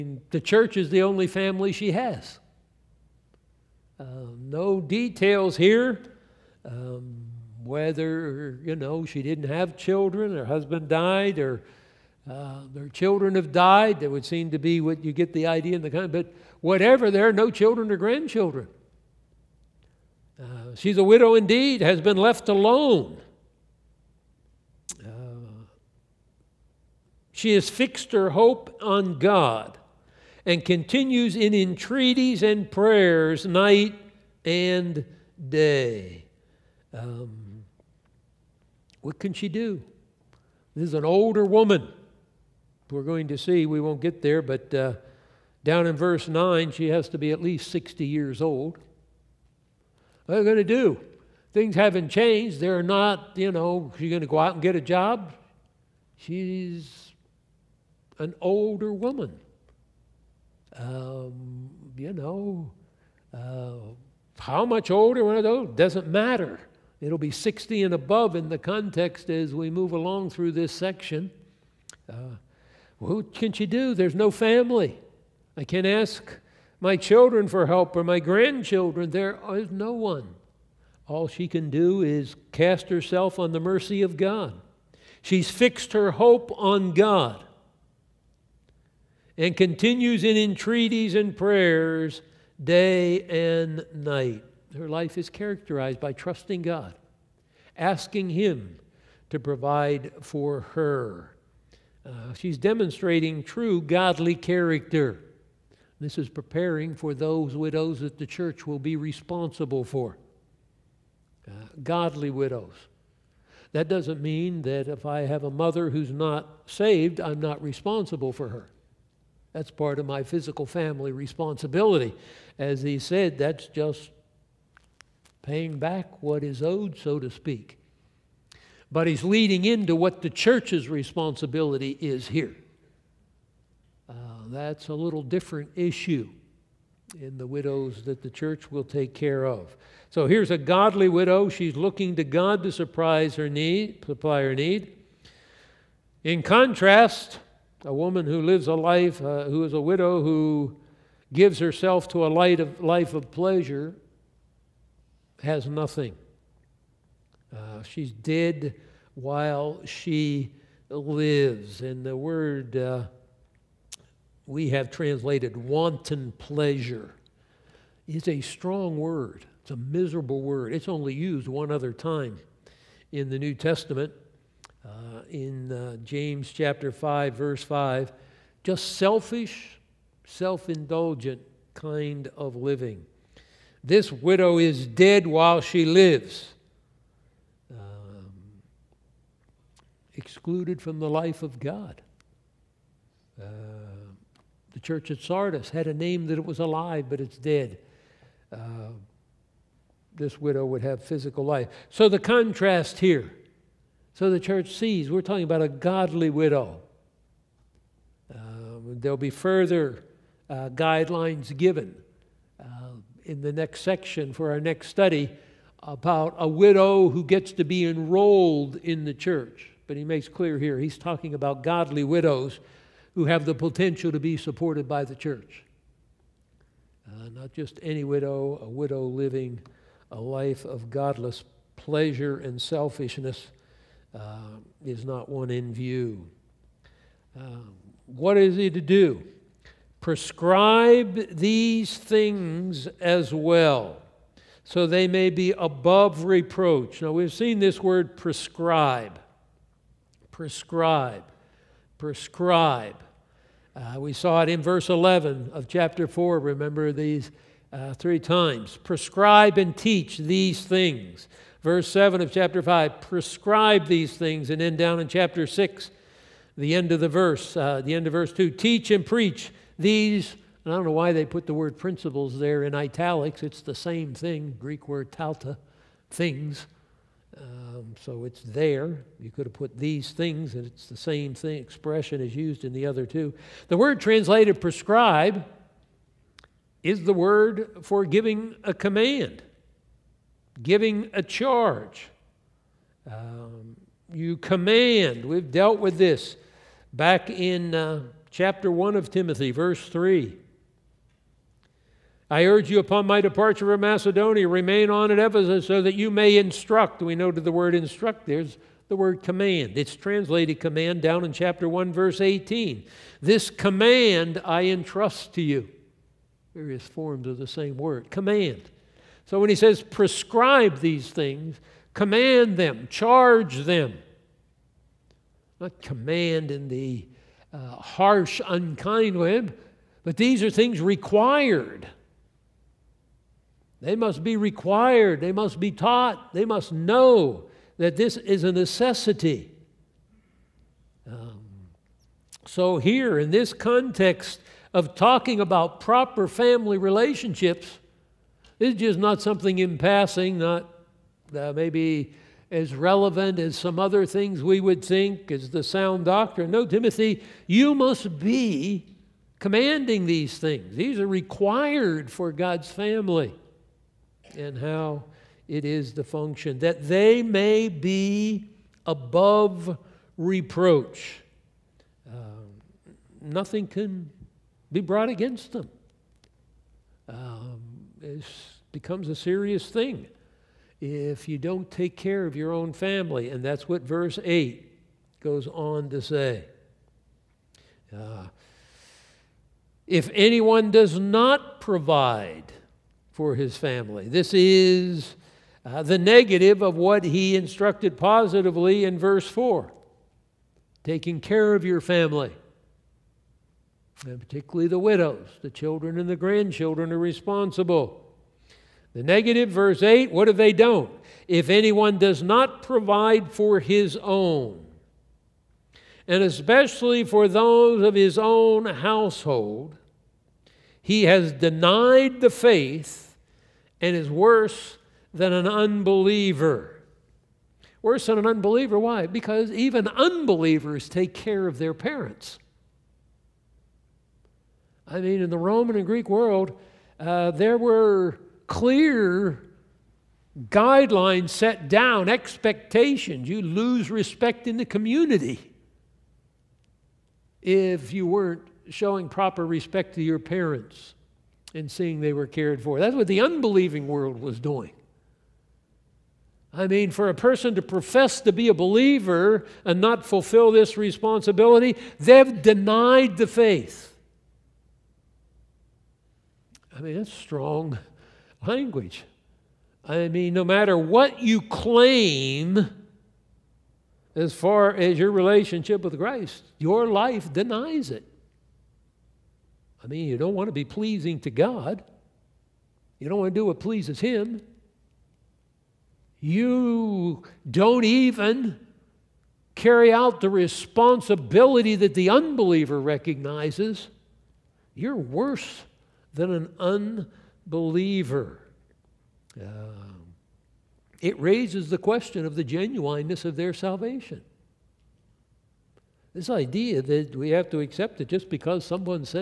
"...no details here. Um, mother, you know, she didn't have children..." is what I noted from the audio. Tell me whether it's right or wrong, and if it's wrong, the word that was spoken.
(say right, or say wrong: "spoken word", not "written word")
wrong: "whether", not "mother".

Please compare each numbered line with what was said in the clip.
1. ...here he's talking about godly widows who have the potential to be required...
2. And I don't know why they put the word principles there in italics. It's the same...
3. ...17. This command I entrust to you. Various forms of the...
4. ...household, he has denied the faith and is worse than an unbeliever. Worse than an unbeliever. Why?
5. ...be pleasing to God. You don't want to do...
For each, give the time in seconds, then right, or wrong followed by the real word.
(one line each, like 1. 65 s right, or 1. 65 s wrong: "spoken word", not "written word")
1. 220 s wrong: "supported", not "required"
2. 270 s right
3. 312 s wrong: "18", not "17"
4. 418 s right
5. 480 s right.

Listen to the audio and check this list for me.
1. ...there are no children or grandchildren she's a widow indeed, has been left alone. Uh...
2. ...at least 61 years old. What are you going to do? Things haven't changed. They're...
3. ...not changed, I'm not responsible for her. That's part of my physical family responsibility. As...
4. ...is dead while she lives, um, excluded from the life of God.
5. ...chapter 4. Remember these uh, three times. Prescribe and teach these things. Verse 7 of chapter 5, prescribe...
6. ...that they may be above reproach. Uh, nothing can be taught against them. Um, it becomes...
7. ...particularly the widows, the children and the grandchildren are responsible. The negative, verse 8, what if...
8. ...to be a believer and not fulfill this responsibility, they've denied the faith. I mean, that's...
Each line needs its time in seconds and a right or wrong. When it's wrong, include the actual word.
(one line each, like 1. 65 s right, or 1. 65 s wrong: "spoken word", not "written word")
1. 17 s right
2. 47 s wrong: "60", not "61"
3. 116 s wrong: "saved", not "changed"
4. 184 s right
5. 255 s right
6. 366 s wrong: "brought", not "taught"
7. 404 s right
8. 458 s right.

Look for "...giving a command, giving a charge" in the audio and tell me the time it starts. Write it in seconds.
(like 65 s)
288 s.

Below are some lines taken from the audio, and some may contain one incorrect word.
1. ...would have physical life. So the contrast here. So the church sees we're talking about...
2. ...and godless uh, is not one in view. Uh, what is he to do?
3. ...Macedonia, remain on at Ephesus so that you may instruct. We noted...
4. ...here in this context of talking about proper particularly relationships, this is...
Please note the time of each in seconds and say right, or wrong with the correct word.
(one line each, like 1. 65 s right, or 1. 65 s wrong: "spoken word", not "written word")
1. 200 s right
2. 232 s wrong: "selfishness", not "godless"
3. 303 s right
4. 342 s wrong: "family", not "particularly".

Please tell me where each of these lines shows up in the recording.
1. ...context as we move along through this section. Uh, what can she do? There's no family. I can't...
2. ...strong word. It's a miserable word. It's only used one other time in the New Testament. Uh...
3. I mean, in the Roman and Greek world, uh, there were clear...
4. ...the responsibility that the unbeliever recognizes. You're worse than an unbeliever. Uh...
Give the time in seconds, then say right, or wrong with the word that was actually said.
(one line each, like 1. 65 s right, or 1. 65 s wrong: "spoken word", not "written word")
1. 68 s right
2. 168 s right
3. 434 s right
4. 490 s right.